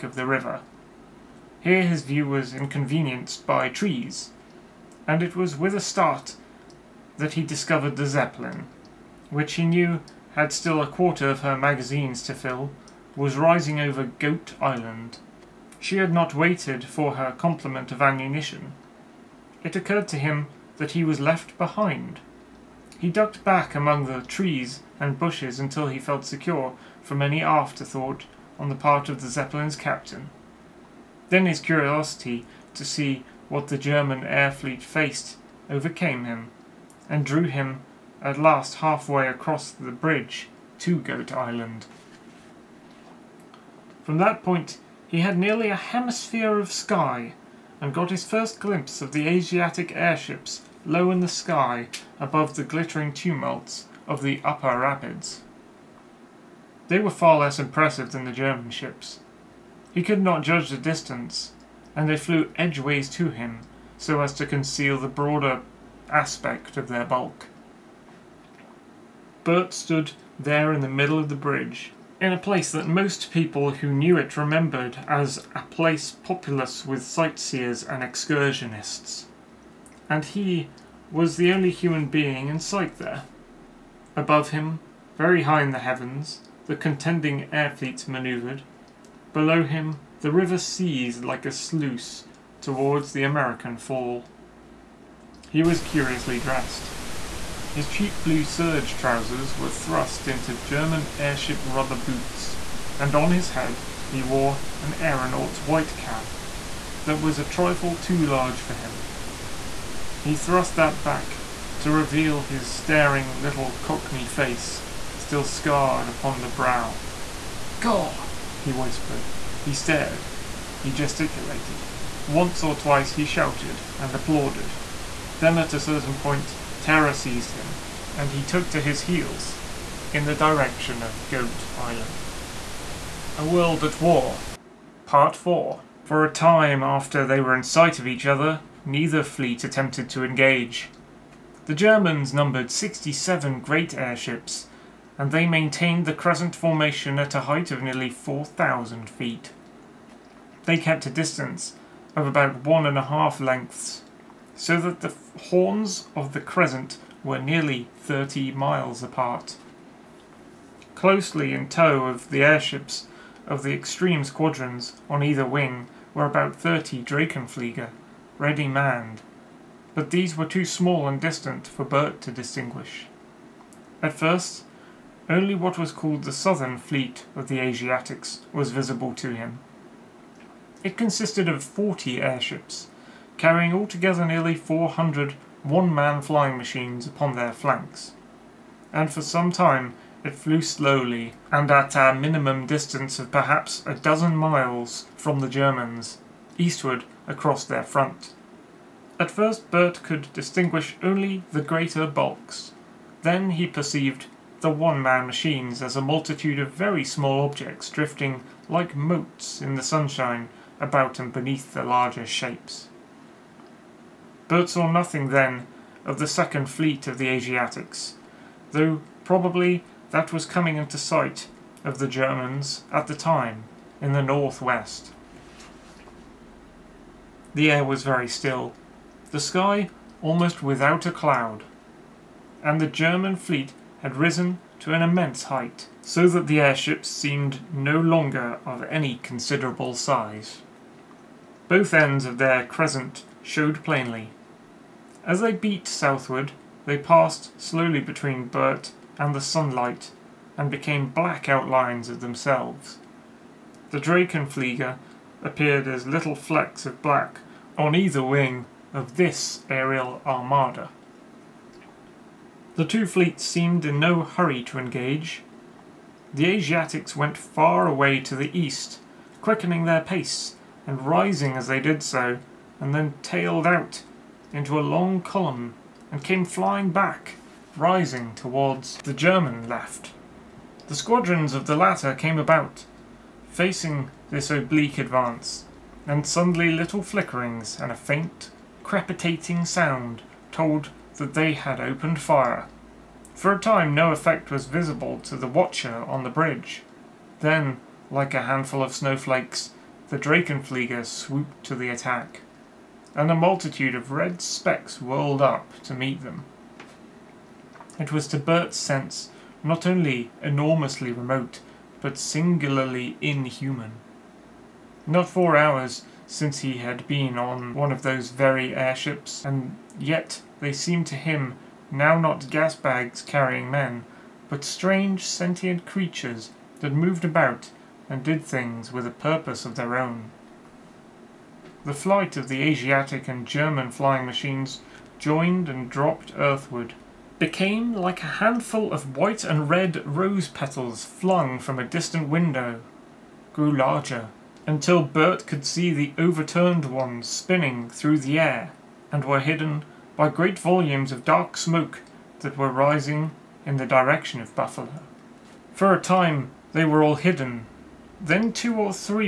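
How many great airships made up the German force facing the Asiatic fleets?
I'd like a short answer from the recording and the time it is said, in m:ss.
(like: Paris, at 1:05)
67, at 2:22.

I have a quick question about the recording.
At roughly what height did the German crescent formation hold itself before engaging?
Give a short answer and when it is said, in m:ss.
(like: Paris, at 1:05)
4,000 feet, at 2:28.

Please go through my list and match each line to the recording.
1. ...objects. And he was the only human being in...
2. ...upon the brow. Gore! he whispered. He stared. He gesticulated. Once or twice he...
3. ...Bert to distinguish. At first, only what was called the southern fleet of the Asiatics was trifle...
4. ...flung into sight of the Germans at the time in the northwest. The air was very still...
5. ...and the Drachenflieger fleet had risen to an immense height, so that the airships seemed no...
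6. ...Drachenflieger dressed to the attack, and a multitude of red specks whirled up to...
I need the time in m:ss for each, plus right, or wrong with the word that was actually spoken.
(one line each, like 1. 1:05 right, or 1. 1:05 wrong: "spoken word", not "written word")
1. 1:18 wrong: "excursionists", not "objects"
2. 1:56 right
3. 2:51 wrong: "visible", not "trifle"
4. 3:40 wrong: "coming", not "flung"
5. 3:52 wrong: "German", not "Drachenflieger"
6. 5:00 wrong: "swooped", not "dressed".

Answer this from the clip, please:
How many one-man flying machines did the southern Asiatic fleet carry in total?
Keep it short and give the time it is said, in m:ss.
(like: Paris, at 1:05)
400, at 3:04.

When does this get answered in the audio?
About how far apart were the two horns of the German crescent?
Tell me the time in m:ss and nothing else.
2:37.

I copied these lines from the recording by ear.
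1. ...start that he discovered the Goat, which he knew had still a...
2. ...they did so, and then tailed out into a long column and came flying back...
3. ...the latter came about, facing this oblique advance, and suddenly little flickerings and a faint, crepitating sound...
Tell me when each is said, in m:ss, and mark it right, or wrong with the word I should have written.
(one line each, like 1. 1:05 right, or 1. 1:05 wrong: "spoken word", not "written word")
1. 0:05 wrong: "Zeppelin", not "Goat"
2. 4:31 right
3. 4:41 right.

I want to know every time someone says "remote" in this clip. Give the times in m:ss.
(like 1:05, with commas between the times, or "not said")
5:11.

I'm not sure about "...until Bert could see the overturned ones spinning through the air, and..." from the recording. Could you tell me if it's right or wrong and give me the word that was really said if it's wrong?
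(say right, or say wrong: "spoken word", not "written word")
right.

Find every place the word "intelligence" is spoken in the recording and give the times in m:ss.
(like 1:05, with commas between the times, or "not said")
not said.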